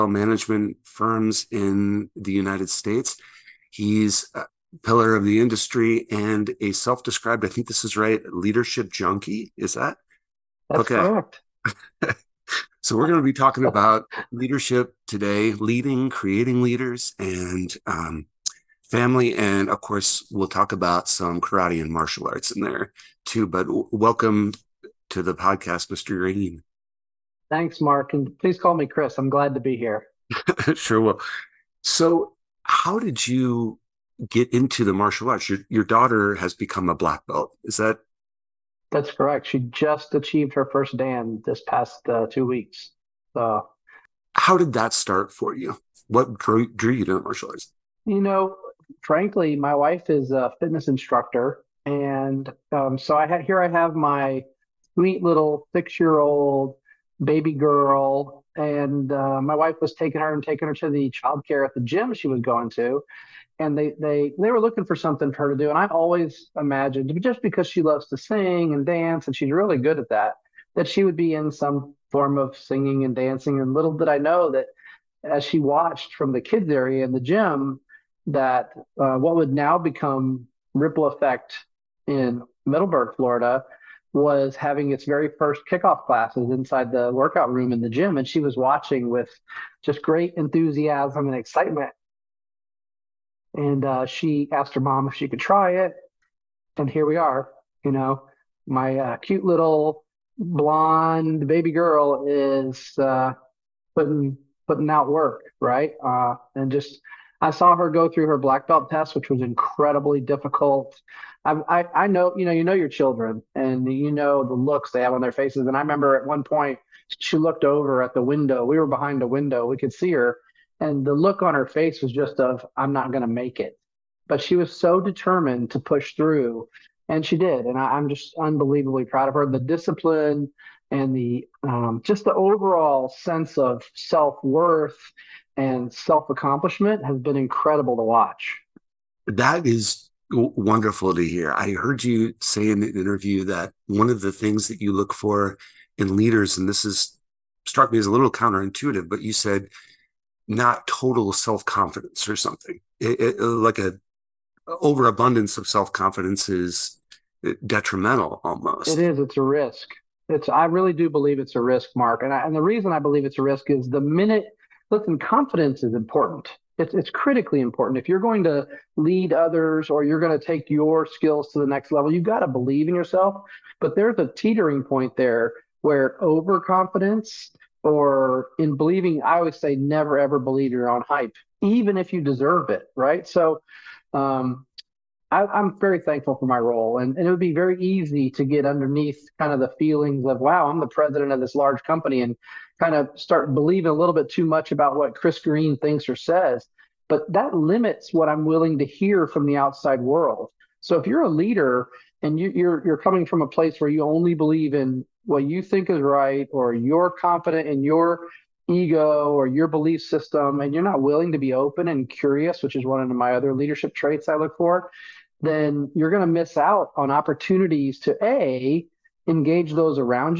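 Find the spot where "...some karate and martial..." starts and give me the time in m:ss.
0:21.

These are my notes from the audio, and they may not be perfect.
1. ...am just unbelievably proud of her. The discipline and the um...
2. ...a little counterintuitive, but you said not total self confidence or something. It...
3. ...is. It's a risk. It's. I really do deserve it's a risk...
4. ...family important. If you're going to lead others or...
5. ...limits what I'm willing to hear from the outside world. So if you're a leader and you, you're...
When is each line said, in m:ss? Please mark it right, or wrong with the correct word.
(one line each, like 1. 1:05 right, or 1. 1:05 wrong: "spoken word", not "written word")
1. 2:07 right
2. 2:28 right
3. 2:39 wrong: "believe", not "deserve"
4. 2:47 wrong: "critically", not "family"
5. 3:17 right.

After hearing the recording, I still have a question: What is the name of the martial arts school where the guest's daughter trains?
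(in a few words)
Ripple Effect.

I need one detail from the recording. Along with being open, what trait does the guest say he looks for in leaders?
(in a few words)
curious.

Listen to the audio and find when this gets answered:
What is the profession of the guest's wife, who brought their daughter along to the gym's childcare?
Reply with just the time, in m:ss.
0:50.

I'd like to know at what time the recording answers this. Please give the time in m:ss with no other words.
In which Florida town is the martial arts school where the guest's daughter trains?
1:22.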